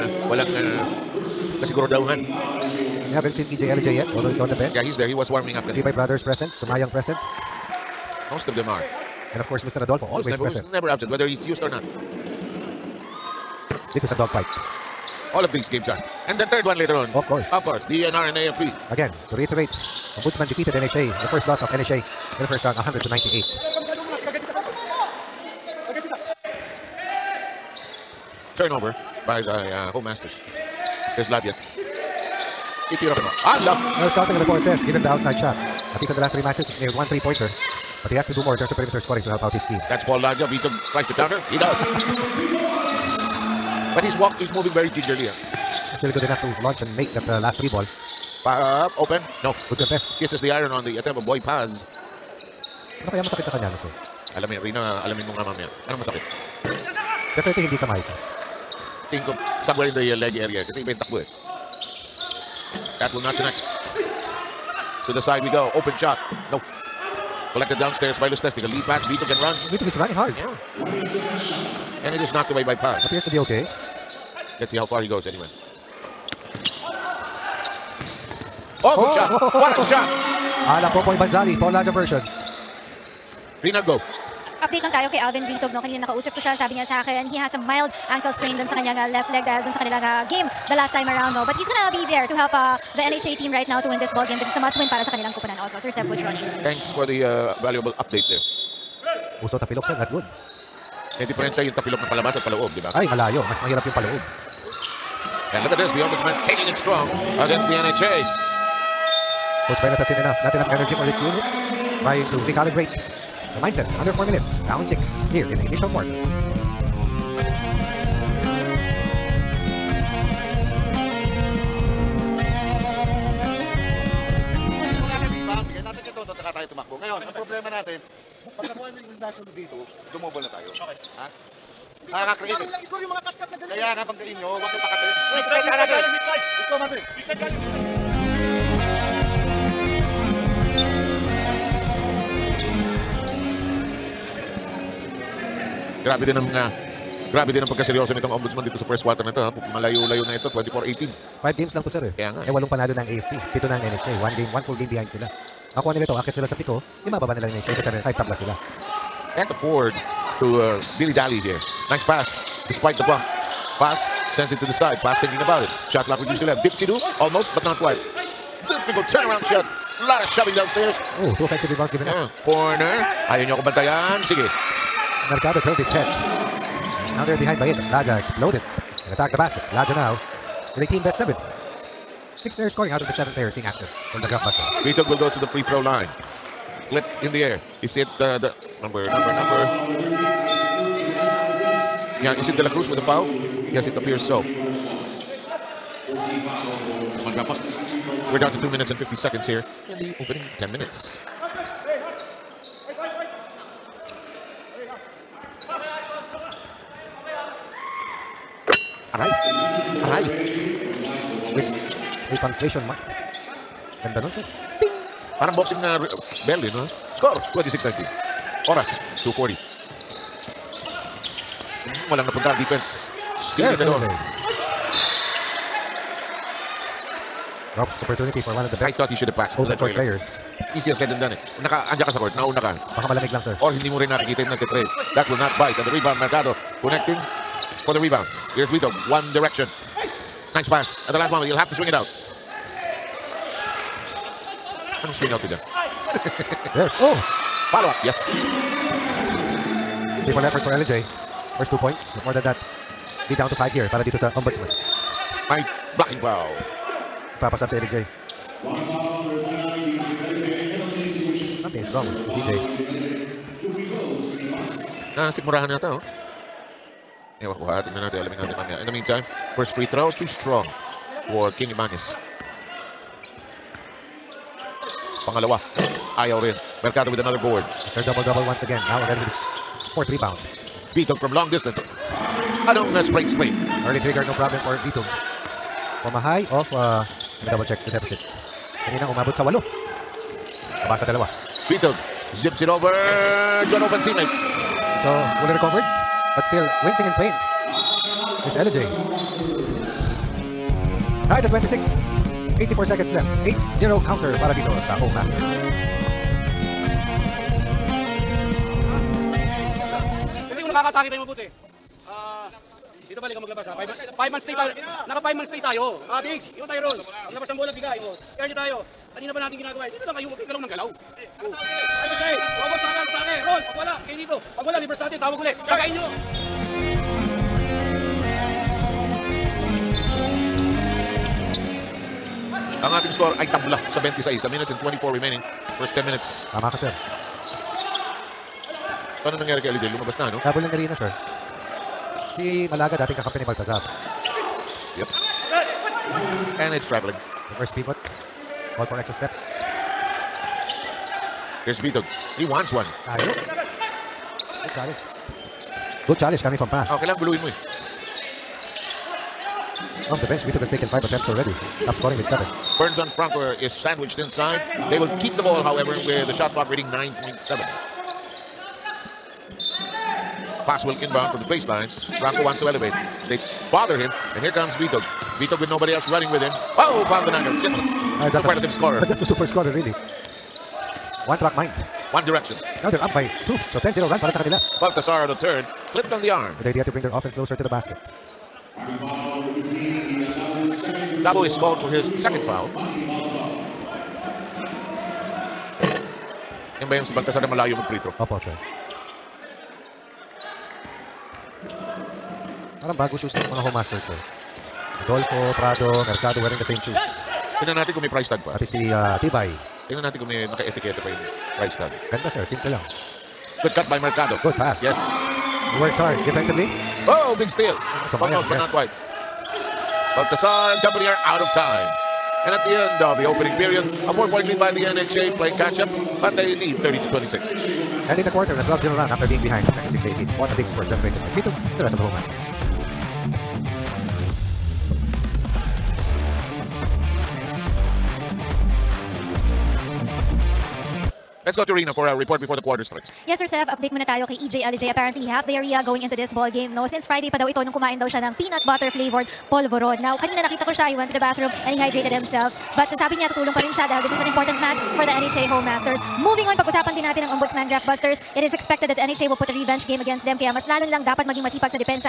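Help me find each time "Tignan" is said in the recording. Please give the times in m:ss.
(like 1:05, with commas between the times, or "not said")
4:27, 6:47.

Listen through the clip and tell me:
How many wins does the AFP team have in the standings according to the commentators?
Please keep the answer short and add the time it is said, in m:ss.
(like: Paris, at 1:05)
8, at 2:32.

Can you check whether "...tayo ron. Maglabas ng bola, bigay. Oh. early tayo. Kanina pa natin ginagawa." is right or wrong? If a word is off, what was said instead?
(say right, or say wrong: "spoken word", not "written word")
right.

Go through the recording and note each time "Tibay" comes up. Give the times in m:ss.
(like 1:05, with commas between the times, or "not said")
0:05, 6:49.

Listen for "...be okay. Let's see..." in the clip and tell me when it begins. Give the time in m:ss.
1:13.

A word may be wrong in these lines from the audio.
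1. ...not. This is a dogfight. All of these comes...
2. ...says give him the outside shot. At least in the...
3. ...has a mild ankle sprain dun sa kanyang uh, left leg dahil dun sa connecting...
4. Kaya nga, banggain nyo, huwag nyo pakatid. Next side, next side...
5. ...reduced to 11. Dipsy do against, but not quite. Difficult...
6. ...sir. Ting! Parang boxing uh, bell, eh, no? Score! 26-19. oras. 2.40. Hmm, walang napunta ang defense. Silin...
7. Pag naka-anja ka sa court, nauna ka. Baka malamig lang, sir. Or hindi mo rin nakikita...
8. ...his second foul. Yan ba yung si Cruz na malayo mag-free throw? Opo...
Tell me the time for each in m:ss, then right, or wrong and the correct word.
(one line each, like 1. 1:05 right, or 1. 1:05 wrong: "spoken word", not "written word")
1. 0:11 wrong: "games", not "comes"
2. 0:34 right
3. 1:27 wrong: "kanilang", not "connecting"
4. 2:13 right
5. 2:46 wrong: "almost", not "against"
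6. 3:34 right
7. 3:51 right
8. 6:31 wrong: "Baltasar", not "Cruz".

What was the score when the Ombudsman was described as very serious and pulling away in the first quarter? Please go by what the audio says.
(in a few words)
24-18.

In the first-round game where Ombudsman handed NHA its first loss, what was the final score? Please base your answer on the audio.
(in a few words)
100 to 98.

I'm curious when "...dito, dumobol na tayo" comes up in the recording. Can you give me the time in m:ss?
2:09.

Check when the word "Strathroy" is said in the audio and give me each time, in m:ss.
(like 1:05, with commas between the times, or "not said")
not said.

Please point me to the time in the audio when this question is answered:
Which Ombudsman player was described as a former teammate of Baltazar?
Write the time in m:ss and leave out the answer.
5:42.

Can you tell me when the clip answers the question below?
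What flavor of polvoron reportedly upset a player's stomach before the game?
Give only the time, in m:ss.
7:28.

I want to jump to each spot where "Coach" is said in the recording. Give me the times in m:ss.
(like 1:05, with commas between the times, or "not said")
1:36, 1:49.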